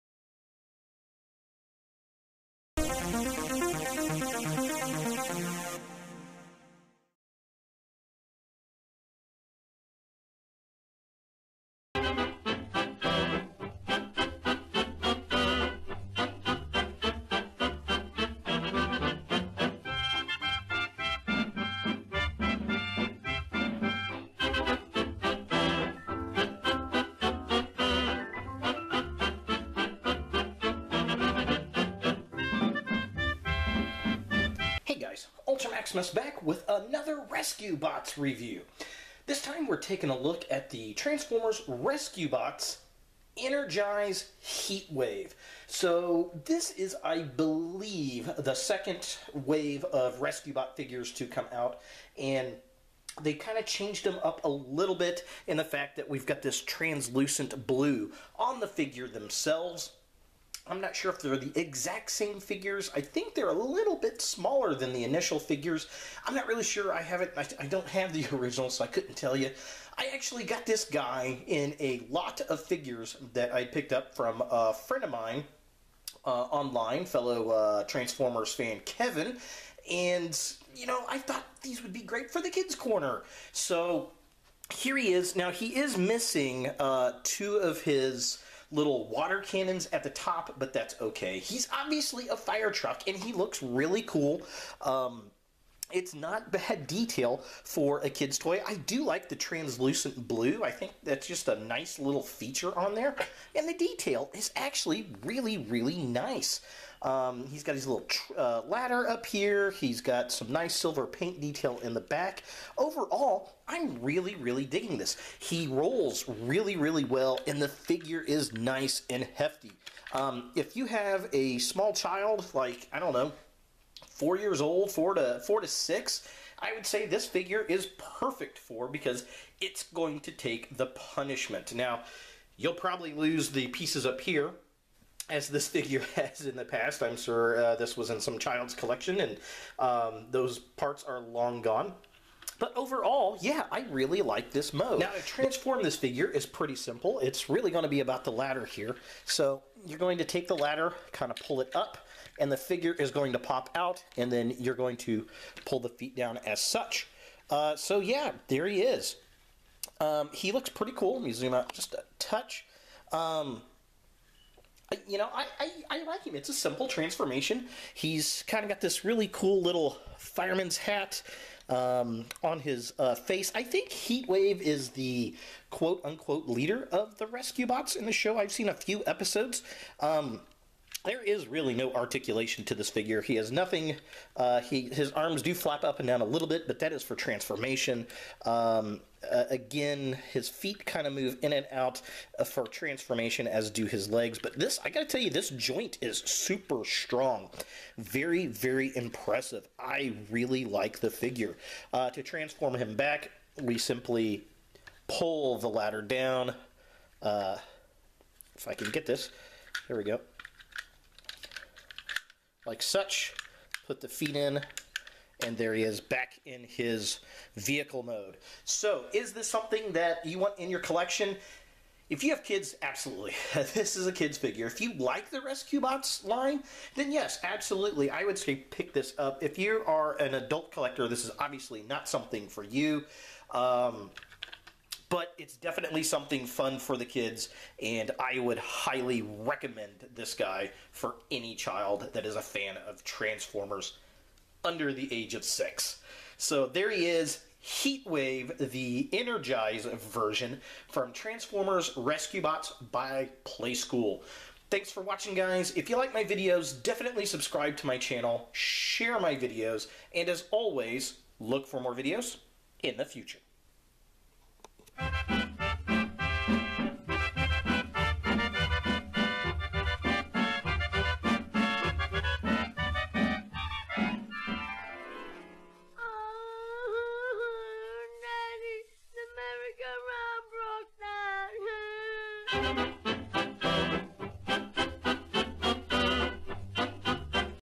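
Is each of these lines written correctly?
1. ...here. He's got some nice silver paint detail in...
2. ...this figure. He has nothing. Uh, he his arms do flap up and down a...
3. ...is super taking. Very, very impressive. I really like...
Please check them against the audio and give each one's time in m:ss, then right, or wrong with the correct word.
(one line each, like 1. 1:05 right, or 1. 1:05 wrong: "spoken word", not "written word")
1. 1:49 right
2. 3:02 right
3. 3:16 wrong: "strong", not "taking".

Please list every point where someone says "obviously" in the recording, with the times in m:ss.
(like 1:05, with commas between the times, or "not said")
1:31, 3:51.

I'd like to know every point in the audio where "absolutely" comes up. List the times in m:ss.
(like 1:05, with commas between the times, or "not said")
3:42, 3:47.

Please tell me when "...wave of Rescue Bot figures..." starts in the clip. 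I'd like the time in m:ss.
0:49.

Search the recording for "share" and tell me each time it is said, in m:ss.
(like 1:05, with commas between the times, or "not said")
4:18.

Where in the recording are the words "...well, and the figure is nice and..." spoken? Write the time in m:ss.
1:57.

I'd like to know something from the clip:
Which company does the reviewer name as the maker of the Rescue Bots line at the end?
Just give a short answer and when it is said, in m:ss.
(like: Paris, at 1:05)
Playskool, at 4:13.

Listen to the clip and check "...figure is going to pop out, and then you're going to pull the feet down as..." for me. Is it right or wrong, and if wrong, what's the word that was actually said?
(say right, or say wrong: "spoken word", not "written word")
right.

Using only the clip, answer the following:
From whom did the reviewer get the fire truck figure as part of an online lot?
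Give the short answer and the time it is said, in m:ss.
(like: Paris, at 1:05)
Kevin, at 1:18.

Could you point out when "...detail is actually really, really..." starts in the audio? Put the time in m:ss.
1:43.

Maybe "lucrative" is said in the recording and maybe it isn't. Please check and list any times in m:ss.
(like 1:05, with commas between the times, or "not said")
not said.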